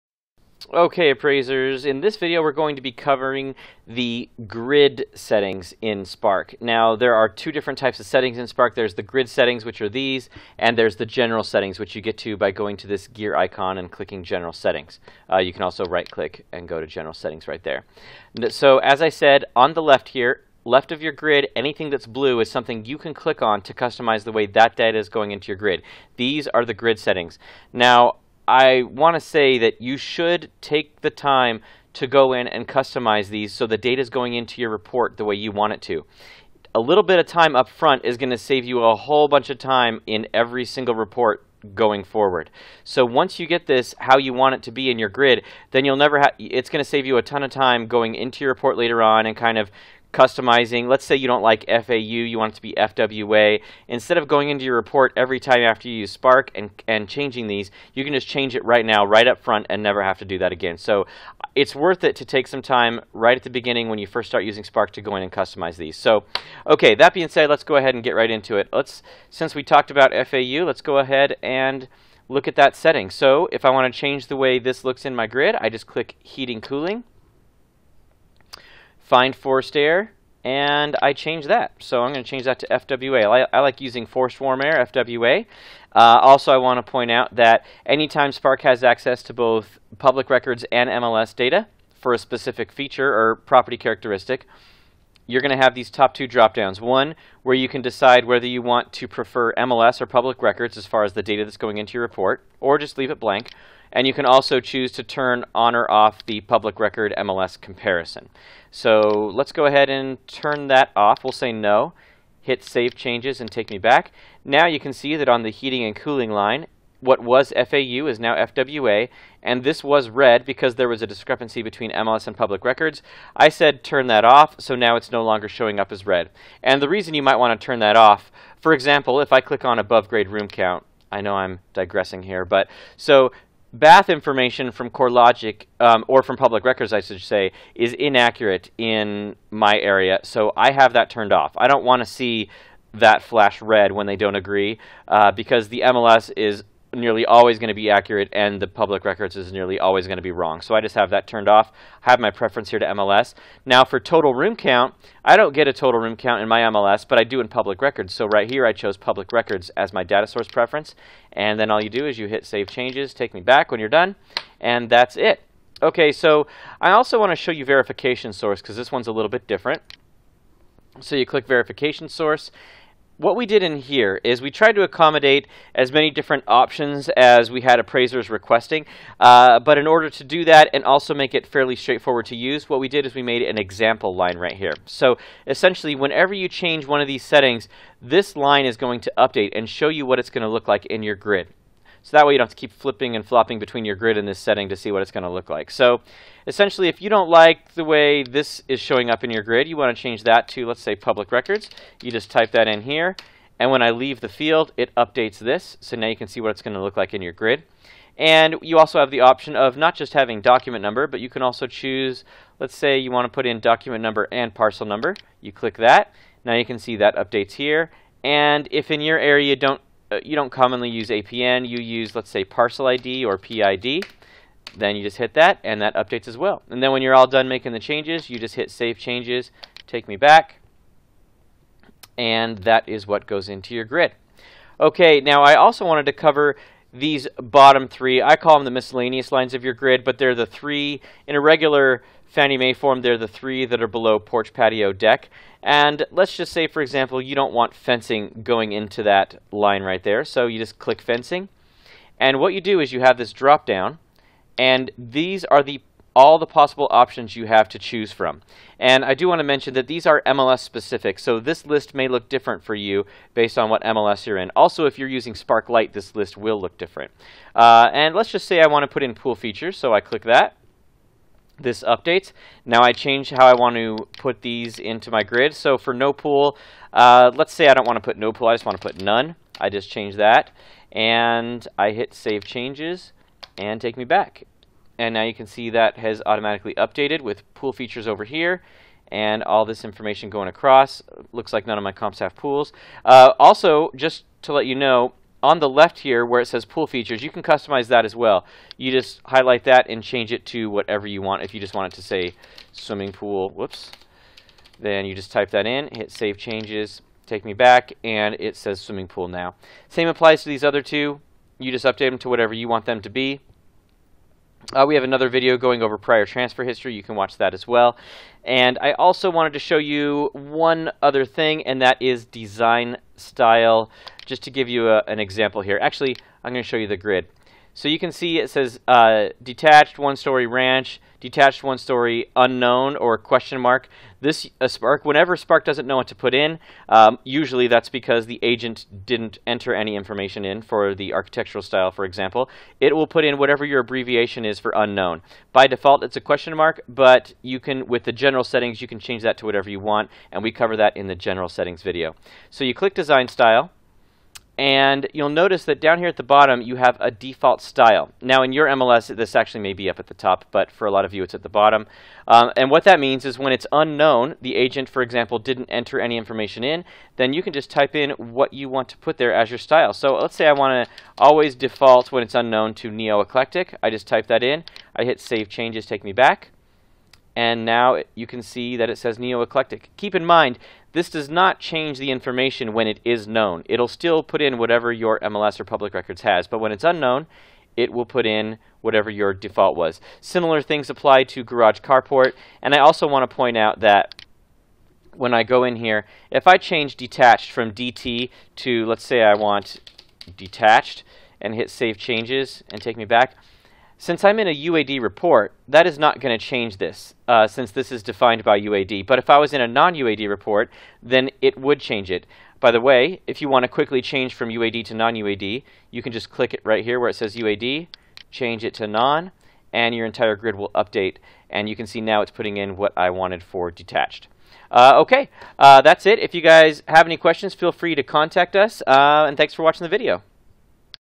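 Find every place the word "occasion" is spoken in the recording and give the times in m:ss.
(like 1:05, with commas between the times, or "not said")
not said.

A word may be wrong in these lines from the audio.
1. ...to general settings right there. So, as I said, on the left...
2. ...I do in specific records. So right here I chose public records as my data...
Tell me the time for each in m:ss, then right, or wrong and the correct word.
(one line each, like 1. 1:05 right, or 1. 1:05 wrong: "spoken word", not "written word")
1. 0:16 right
2. 2:37 wrong: "public", not "specific".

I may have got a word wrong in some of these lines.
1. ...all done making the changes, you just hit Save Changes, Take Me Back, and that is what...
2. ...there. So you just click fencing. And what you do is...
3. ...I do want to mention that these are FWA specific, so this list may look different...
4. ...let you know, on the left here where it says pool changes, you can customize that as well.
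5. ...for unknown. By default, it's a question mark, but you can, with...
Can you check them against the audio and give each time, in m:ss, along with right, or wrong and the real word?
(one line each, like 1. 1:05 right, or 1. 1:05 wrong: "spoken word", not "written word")
1. 3:47 right
2. 4:10 right
3. 4:19 wrong: "MLS", not "FWA"
4. 4:54 wrong: "features", not "changes"
5. 5:44 right.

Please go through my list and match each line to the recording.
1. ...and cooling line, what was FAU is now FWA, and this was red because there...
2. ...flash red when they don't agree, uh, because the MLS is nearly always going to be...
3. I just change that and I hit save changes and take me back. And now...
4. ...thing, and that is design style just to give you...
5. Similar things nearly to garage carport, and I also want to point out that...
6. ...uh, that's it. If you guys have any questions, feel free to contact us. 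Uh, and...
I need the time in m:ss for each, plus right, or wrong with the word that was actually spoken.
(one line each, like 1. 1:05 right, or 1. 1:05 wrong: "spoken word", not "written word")
1. 1:55 right
2. 2:23 right
3. 4:39 right
4. 5:21 right
5. 6:30 wrong: "apply", not "nearly"
6. 7:05 right.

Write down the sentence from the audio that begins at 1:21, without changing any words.
So I'm going to change that to FWA.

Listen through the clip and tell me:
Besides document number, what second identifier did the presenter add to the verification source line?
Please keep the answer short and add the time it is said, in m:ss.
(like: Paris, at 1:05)
parcel number, at 3:33.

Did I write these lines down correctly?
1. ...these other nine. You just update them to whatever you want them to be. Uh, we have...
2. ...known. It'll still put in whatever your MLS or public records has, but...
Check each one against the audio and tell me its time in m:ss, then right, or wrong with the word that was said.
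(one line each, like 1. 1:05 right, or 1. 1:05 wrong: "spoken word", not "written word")
1. 5:10 wrong: "two", not "nine"
2. 6:23 right.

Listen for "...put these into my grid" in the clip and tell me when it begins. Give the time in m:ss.
4:34.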